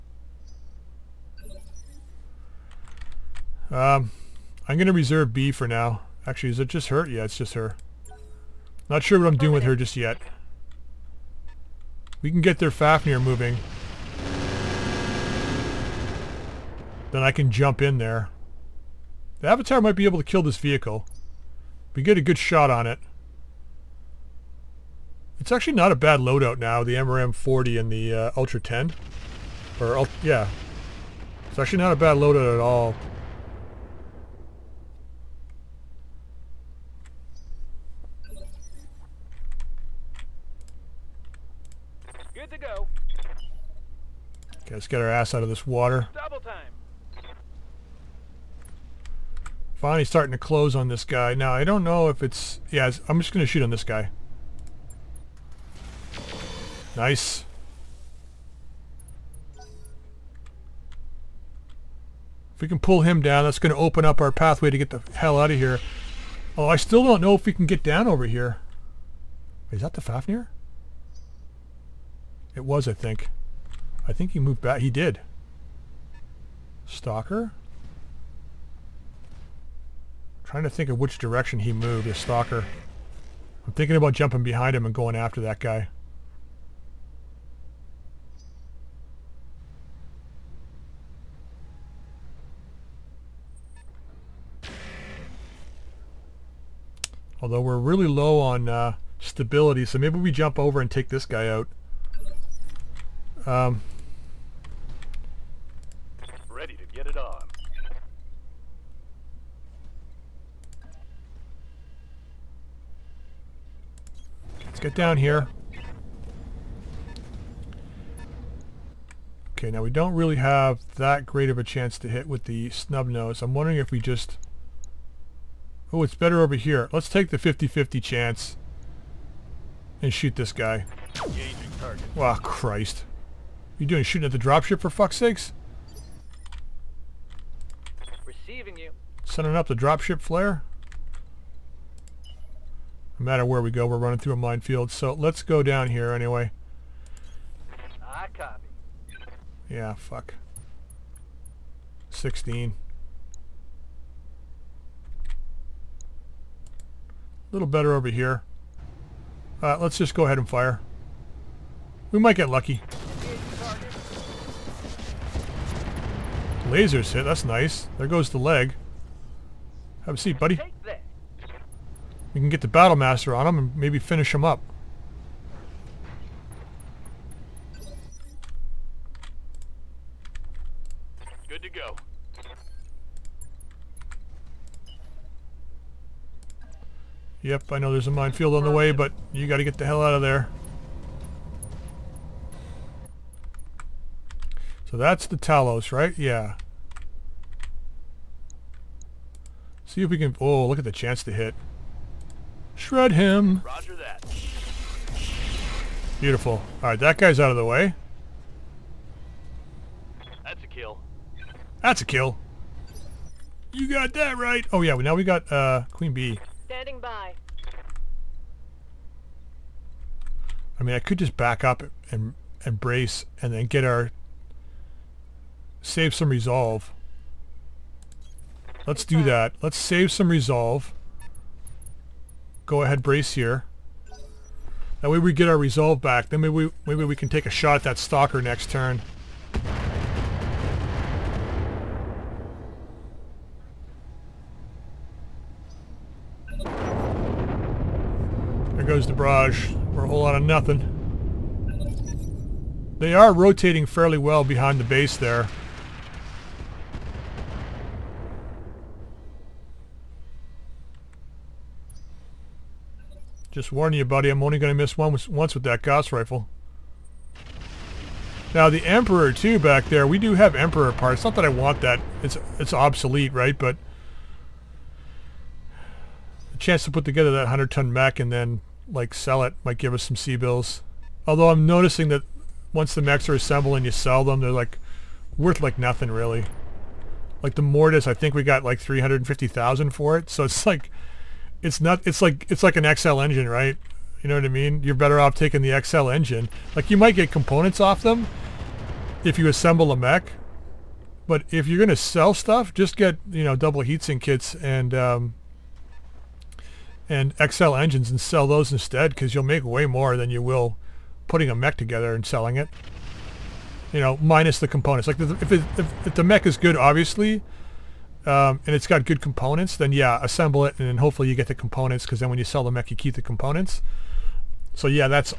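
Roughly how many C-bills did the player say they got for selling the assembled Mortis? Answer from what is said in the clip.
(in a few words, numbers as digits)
350000.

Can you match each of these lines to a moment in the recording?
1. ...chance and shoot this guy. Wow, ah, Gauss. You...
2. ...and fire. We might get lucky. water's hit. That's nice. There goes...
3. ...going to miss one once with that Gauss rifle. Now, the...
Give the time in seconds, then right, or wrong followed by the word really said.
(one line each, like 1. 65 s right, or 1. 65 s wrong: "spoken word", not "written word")
1. 128 s wrong: "Christ", not "Gauss"
2. 160 s wrong: "laser", not "water"
3. 264 s right.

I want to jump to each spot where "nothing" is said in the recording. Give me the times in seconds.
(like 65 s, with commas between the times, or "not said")
250 s, 285 s.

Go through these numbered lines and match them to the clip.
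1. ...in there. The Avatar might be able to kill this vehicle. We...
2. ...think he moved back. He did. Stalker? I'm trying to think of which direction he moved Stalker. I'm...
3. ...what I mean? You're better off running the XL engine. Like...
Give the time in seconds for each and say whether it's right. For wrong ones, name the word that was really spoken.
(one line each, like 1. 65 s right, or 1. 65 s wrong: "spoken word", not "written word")
1. 17 s right
2. 74 s right
3. 294 s wrong: "taking", not "running".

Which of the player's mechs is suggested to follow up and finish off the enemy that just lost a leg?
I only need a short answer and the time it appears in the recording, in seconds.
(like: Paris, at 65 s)
Battle Master, at 172 s.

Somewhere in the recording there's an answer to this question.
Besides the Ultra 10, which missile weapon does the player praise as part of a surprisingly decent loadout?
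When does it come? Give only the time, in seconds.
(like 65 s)
26 s.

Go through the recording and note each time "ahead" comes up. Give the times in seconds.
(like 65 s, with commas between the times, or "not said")
160 s, 232 s.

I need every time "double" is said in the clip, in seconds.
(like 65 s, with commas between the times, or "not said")
303 s.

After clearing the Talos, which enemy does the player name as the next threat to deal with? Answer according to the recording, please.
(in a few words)
Queen Bee.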